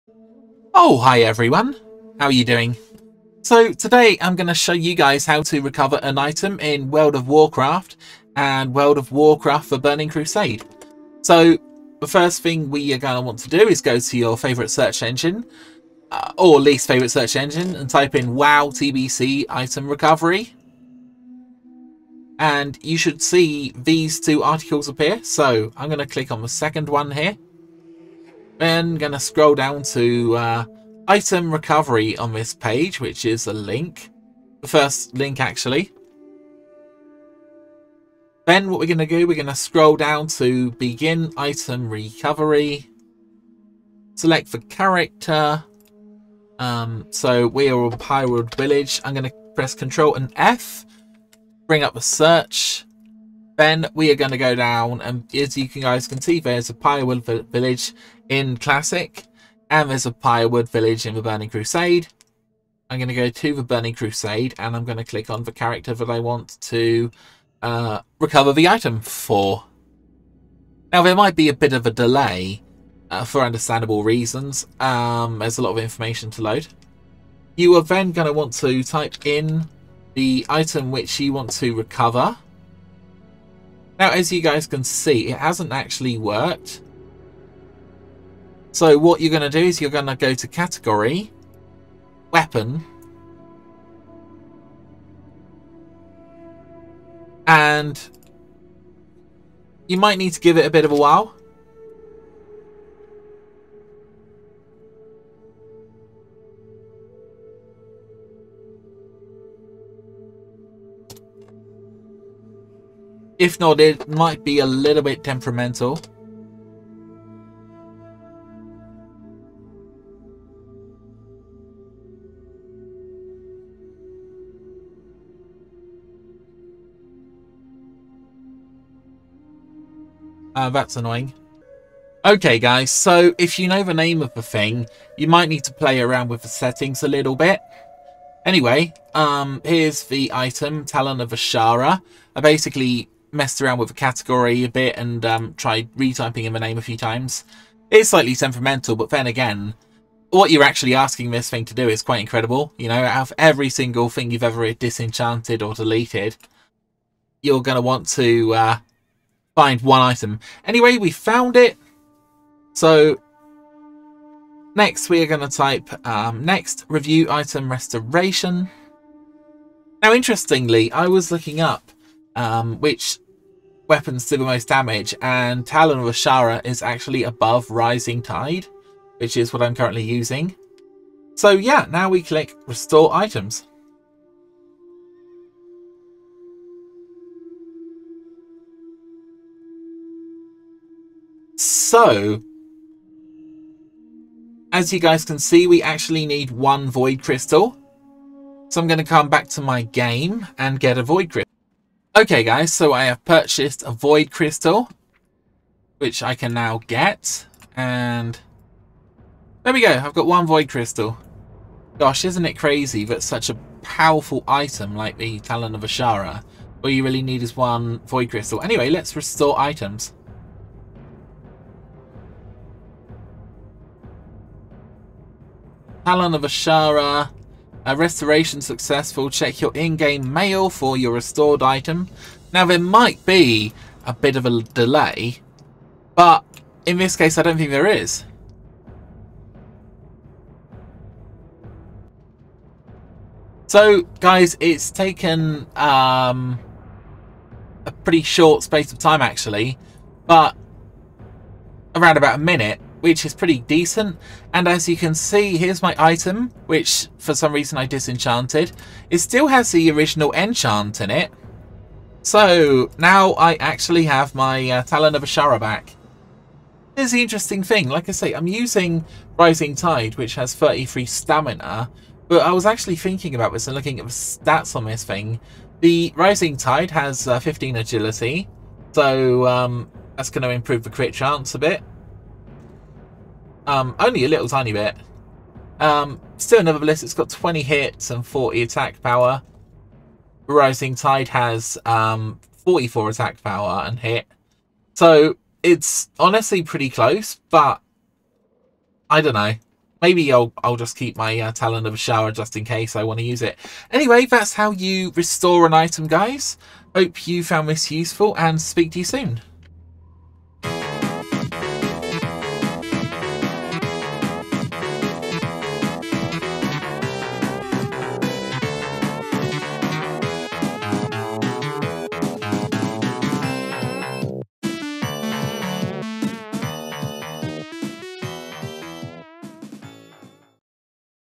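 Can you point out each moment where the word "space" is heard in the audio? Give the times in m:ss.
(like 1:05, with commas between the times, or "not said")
4:08.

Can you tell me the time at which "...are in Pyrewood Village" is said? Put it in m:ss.
0:47.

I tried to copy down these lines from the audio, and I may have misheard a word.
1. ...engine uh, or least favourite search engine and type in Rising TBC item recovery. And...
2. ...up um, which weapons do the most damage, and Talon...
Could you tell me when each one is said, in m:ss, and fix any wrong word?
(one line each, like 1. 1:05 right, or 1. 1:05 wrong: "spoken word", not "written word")
1. 0:15 wrong: "WoW", not "Rising"
2. 2:51 right.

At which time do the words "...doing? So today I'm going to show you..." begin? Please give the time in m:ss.
0:02.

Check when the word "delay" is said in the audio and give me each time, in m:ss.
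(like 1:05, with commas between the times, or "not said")
1:11, 3:54.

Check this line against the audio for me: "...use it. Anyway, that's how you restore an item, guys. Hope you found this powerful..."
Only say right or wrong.
wrong.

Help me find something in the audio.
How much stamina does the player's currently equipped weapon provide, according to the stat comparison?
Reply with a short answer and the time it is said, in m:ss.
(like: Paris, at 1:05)
33, at 4:30.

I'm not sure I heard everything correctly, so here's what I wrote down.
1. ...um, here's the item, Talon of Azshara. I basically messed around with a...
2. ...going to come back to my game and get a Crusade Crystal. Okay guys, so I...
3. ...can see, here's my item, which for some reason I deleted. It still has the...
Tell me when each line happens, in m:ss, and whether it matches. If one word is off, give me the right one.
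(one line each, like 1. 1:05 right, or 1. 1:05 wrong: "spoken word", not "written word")
1. 2:19 right
2. 3:18 wrong: "Void", not "Crusade"
3. 4:14 wrong: "disenchanted", not "deleted".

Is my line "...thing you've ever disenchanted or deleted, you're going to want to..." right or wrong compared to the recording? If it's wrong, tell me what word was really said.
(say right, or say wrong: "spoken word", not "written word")
right.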